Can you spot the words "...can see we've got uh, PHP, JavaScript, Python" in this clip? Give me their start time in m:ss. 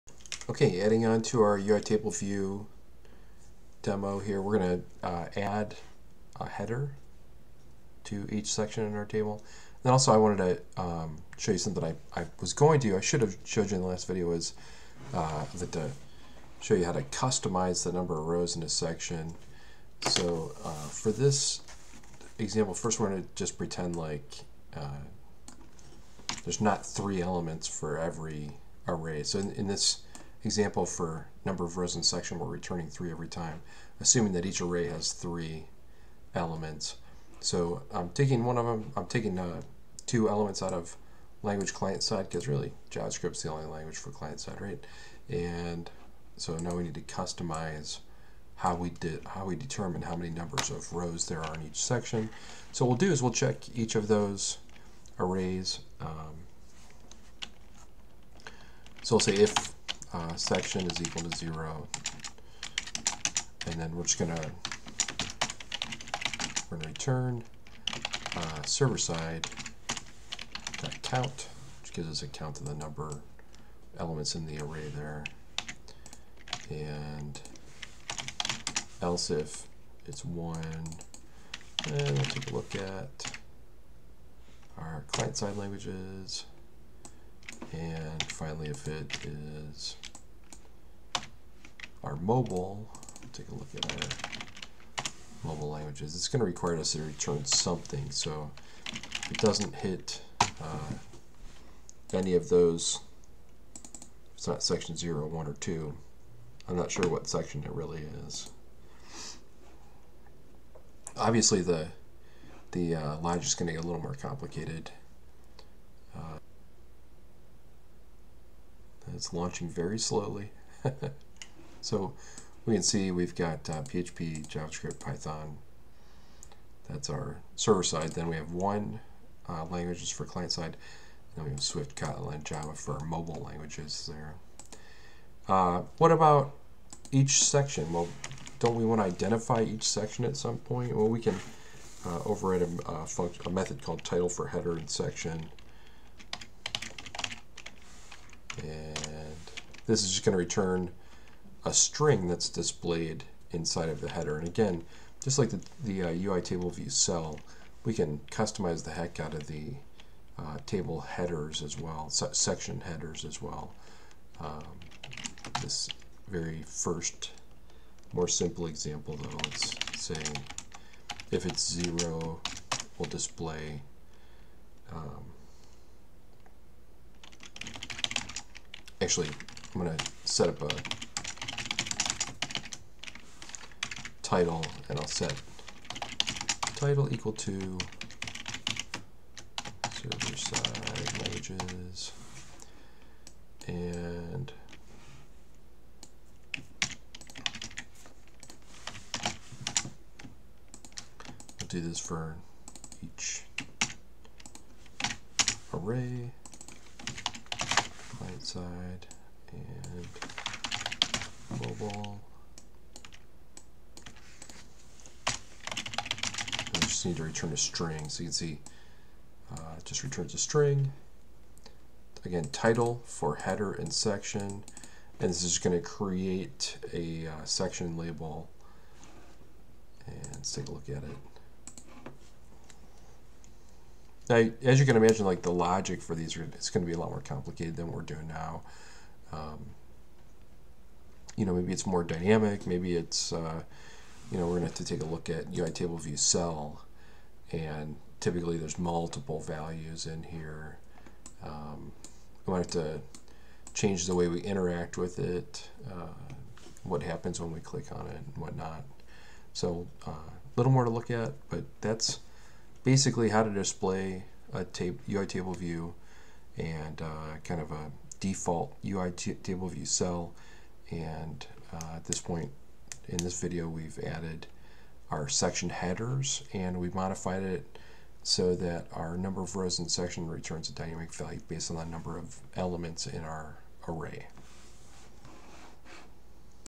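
2:02.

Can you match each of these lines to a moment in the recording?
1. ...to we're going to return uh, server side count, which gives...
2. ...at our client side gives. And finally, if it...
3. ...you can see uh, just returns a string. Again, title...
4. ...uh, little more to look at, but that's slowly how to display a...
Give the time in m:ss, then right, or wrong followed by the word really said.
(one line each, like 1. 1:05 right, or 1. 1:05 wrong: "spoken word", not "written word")
1. 1:04 right
2. 1:22 wrong: "languages", not "gives"
3. 3:38 right
4. 4:20 wrong: "basically", not "slowly".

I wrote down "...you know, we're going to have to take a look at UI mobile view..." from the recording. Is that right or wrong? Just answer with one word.
wrong.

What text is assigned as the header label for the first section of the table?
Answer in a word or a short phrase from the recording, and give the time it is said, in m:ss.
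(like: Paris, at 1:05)
Server side languages, at 3:09.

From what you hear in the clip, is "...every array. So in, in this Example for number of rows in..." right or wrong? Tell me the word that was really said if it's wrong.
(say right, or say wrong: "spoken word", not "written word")
right.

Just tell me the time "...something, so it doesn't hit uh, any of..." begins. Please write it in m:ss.
1:37.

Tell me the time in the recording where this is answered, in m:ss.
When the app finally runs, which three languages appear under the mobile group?
2:11.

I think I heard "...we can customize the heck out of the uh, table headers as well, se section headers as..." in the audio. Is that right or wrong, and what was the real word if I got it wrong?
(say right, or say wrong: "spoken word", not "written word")
right.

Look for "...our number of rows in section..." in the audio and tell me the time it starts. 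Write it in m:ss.
4:38.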